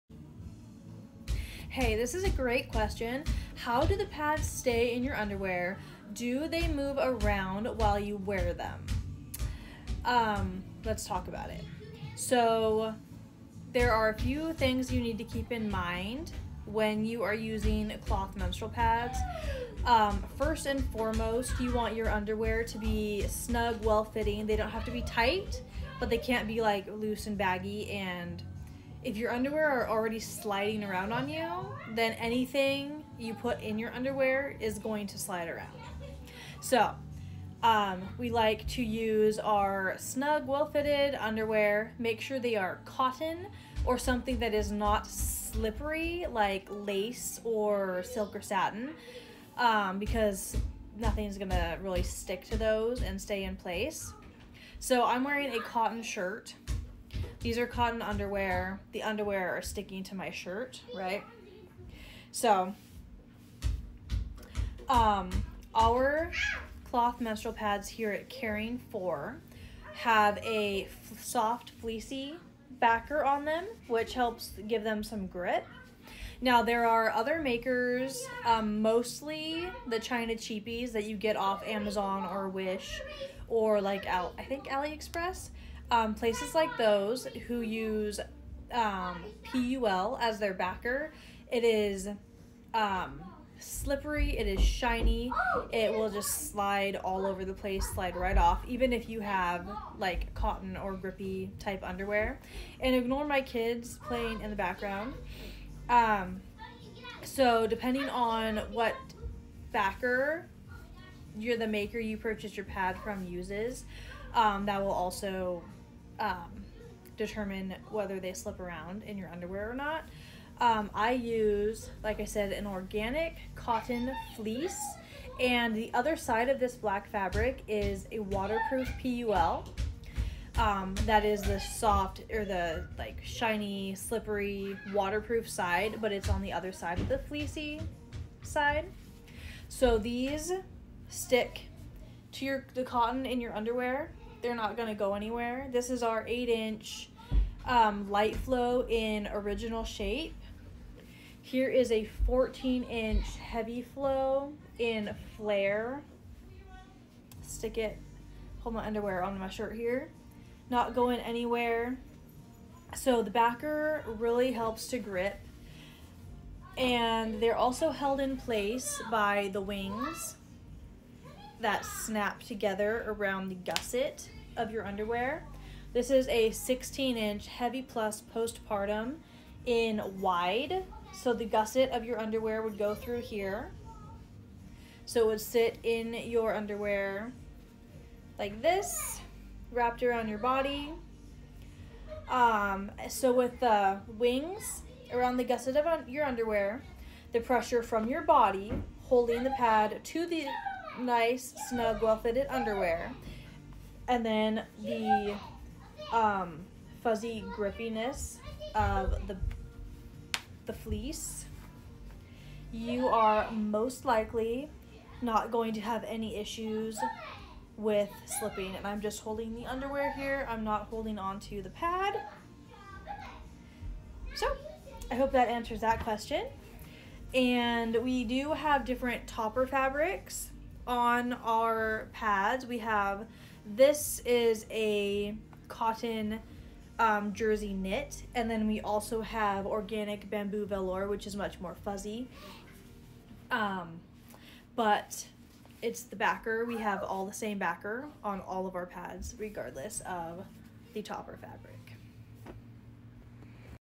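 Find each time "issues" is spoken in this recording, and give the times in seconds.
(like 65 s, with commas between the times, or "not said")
216 s.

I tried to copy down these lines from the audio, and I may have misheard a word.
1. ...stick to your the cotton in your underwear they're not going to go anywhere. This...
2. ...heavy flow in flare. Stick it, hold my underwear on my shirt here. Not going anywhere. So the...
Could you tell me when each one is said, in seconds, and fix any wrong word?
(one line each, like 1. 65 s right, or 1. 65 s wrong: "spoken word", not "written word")
1. 141 s right
2. 153 s right.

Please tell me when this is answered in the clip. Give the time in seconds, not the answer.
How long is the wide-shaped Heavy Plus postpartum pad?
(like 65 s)
176 s.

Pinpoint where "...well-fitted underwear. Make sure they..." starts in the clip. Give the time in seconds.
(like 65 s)
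40 s.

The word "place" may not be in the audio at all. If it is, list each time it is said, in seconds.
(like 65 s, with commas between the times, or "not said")
53 s, 86 s, 97 s, 168 s.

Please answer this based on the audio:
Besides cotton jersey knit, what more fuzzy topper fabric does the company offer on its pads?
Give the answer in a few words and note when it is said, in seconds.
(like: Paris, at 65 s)
organic bamboo velour, at 239 s.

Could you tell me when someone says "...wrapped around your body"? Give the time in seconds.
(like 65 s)
189 s.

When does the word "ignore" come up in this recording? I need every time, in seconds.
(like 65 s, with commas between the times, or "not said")
102 s.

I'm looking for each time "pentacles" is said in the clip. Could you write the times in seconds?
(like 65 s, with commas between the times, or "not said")
not said.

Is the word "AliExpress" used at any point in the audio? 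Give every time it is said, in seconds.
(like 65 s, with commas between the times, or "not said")
84 s.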